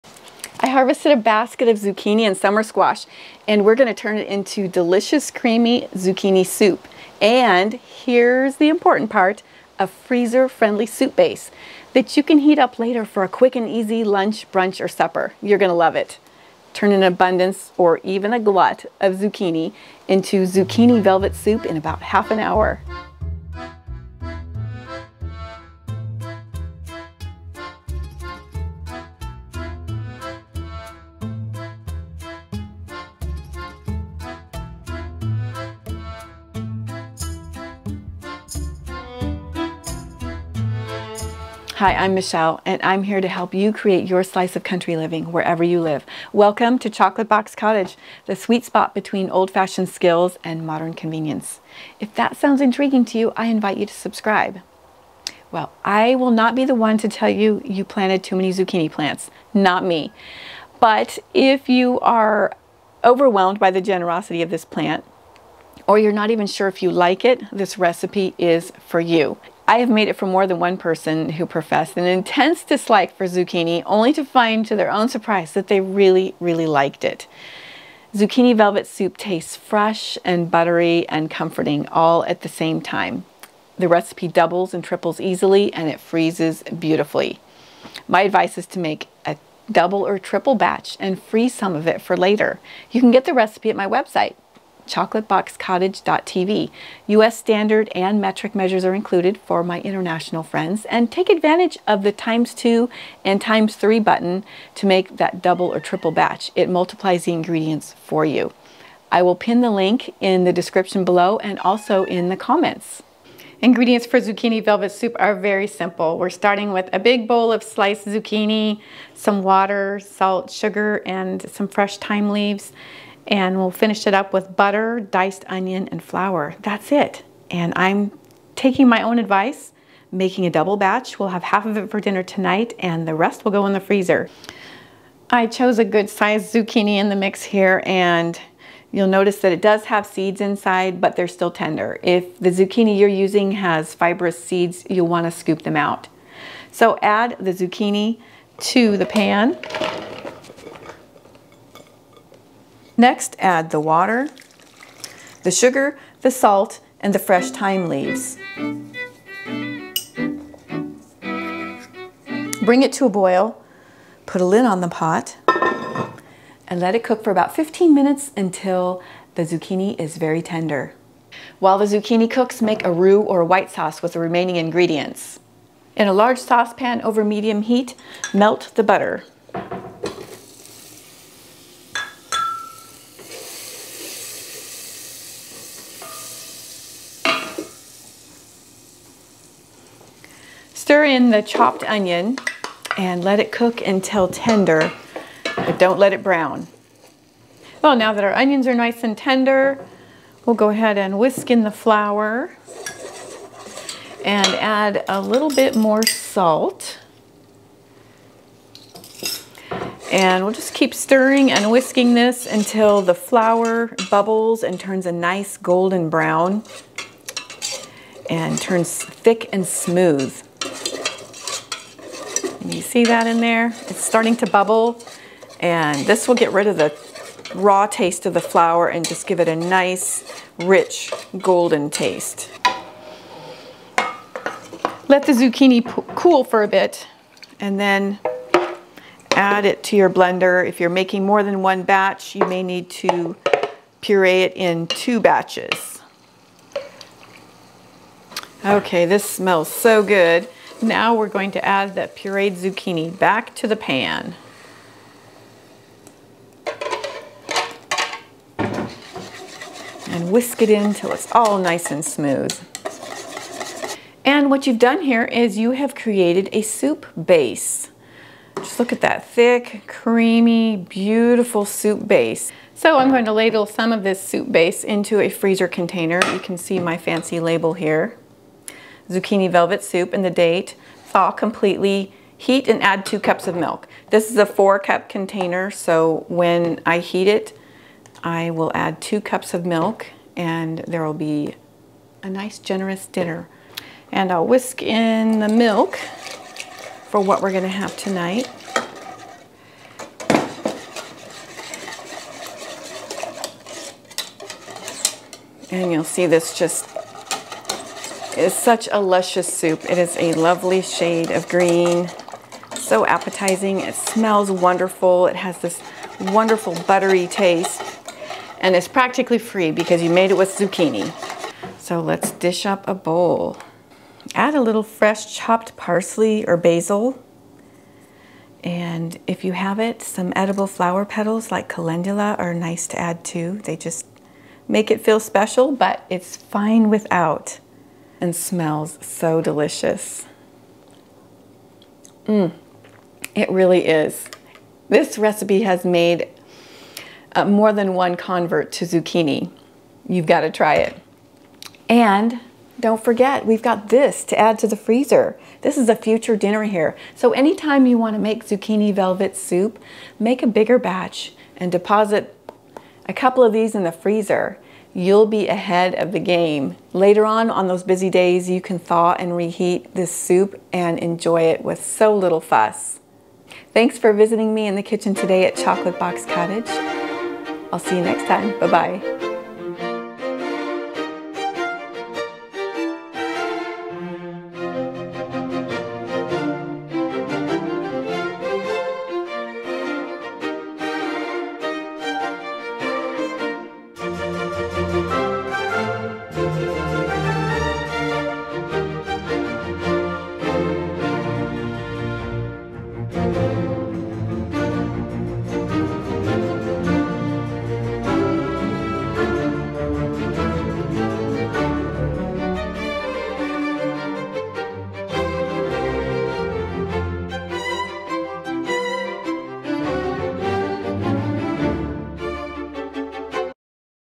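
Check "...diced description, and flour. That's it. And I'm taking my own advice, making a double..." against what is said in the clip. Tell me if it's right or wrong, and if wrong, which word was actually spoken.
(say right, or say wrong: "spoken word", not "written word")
wrong: "onion", not "description".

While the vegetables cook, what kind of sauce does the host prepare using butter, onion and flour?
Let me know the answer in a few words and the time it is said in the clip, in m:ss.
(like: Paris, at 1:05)
roux, at 2:52.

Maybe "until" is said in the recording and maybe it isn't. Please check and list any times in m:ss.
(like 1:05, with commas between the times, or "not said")
2:48, 3:13, 3:32.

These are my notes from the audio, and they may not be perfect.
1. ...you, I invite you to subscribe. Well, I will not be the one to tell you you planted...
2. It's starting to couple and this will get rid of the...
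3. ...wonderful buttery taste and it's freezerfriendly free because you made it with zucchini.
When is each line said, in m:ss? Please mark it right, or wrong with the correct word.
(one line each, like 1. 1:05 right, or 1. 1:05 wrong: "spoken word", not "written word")
1. 0:53 right
2. 3:43 wrong: "bubble", not "couple"
3. 5:16 wrong: "practically", not "freezerfriendly".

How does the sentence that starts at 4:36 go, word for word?
You can see my fancy label here zucchini velvet soup and the date.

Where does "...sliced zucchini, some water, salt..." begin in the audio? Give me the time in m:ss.
1:57.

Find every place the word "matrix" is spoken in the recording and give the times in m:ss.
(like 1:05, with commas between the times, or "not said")
not said.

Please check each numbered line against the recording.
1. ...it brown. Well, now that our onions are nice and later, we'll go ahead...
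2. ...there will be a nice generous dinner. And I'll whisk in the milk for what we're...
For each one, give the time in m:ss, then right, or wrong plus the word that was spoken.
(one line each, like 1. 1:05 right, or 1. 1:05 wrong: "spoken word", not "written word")
1. 3:16 wrong: "tender", not "later"
2. 4:50 right.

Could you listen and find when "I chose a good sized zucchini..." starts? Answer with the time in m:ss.
2:15.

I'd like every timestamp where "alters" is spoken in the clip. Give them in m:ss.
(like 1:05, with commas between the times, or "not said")
not said.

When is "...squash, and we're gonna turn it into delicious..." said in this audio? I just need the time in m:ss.
0:02.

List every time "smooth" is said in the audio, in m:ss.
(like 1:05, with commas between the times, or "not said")
3:39, 4:22.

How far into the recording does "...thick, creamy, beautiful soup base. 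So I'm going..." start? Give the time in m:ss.
4:29.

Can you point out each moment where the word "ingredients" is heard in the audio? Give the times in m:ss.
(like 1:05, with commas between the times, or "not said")
1:47, 1:53, 2:54.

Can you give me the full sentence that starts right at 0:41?
Hi, I'm Michelle, and I'm here to help you create your slice of country living wherever you live.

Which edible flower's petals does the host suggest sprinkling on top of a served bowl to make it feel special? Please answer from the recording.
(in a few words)
calendula.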